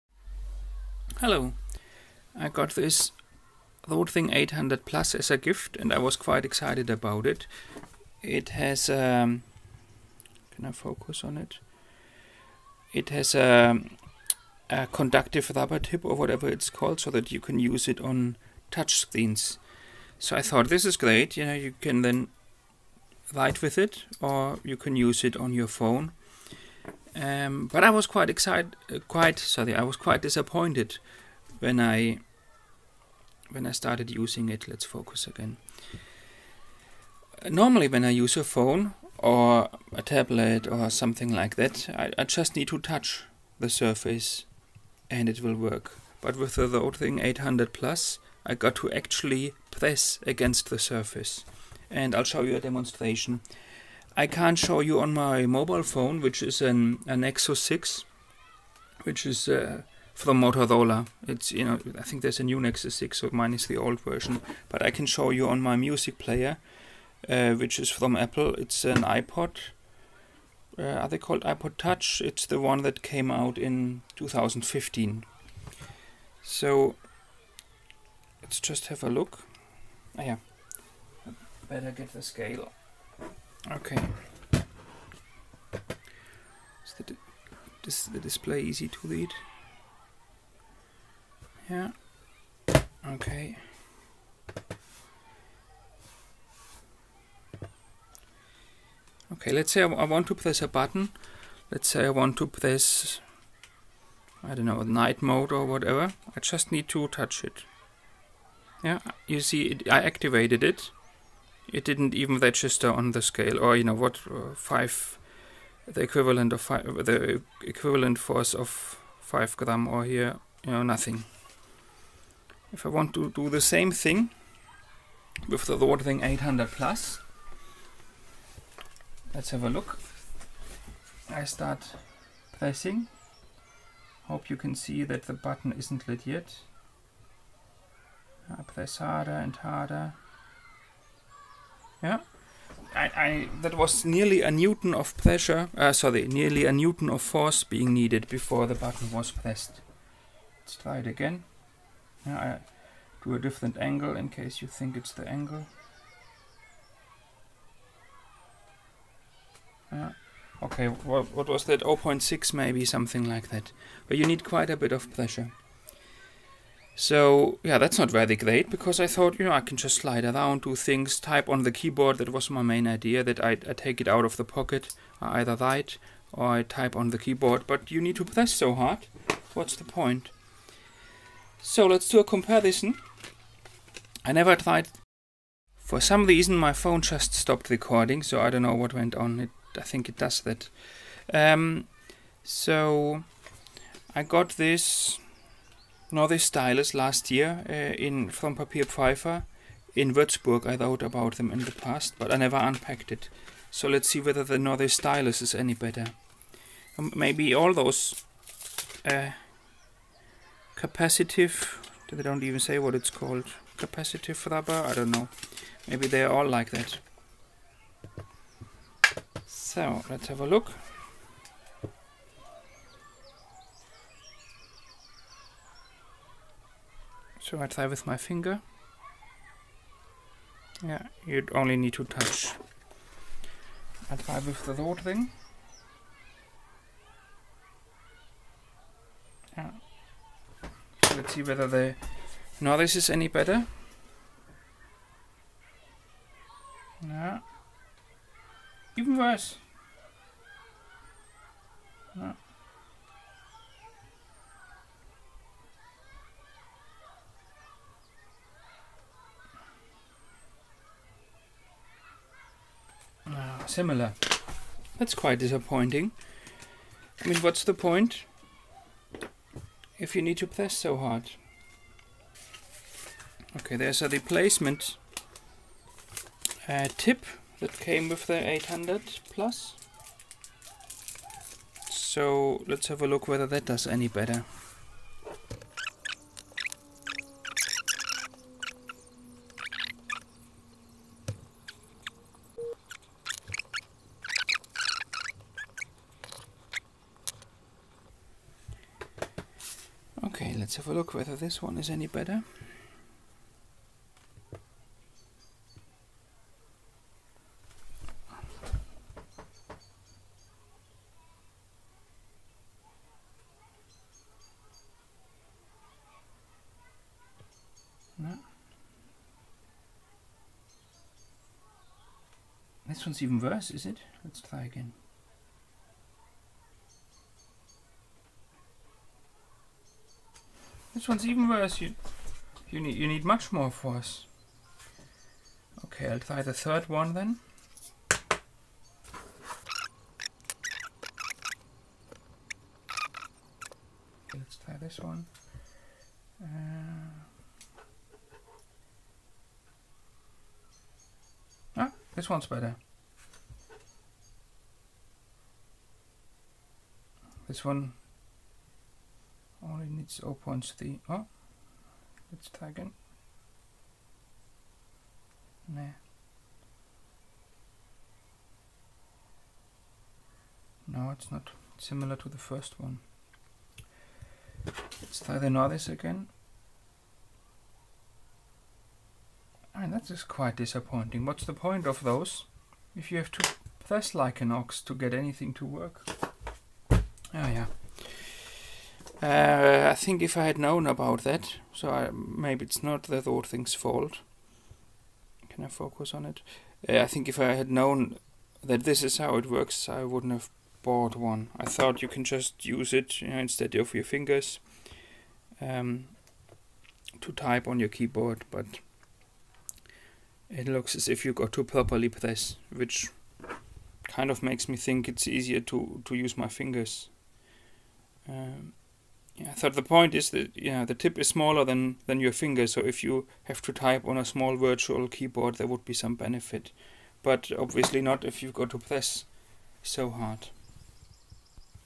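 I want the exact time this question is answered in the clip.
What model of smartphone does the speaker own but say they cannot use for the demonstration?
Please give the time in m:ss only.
0:57.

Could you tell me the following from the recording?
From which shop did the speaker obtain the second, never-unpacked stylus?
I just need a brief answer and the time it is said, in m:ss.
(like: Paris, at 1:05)
Papier Pfeiffer, at 3:18.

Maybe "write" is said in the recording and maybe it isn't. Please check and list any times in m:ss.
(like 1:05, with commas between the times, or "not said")
0:23, 2:55.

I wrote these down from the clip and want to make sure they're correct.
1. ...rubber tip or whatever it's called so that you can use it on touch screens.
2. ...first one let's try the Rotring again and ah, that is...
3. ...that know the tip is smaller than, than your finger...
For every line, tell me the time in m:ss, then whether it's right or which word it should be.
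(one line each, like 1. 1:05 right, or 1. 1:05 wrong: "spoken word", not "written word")
1. 0:15 right
2. 6:12 wrong: "This", not "Rotring"
3. 7:00 right.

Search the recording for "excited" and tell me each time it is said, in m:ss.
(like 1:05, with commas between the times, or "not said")
0:06, 0:28.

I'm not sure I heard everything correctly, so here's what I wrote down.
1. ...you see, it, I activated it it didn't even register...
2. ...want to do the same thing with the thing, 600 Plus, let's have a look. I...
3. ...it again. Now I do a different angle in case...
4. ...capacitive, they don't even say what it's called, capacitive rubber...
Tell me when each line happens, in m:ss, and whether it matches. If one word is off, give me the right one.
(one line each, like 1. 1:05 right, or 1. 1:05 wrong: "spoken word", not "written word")
1. 1:49 right
2. 2:02 wrong: "800", not "600"
3. 2:30 right
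4. 3:30 right.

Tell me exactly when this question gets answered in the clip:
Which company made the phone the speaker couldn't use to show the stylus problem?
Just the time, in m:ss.
1:00.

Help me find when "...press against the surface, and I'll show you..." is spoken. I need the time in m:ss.
0:49.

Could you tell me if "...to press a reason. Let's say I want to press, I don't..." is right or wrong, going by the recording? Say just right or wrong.
wrong.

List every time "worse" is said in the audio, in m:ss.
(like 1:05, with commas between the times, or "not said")
4:09, 5:23, 5:31.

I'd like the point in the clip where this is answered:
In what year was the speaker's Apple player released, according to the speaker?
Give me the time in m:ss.
1:14.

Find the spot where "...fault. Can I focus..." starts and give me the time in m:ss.
6:33.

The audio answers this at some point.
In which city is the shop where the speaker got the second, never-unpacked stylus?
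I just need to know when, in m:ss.
3:20.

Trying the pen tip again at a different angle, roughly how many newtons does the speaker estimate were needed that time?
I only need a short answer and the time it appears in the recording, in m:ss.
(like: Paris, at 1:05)
0.6, at 2:41.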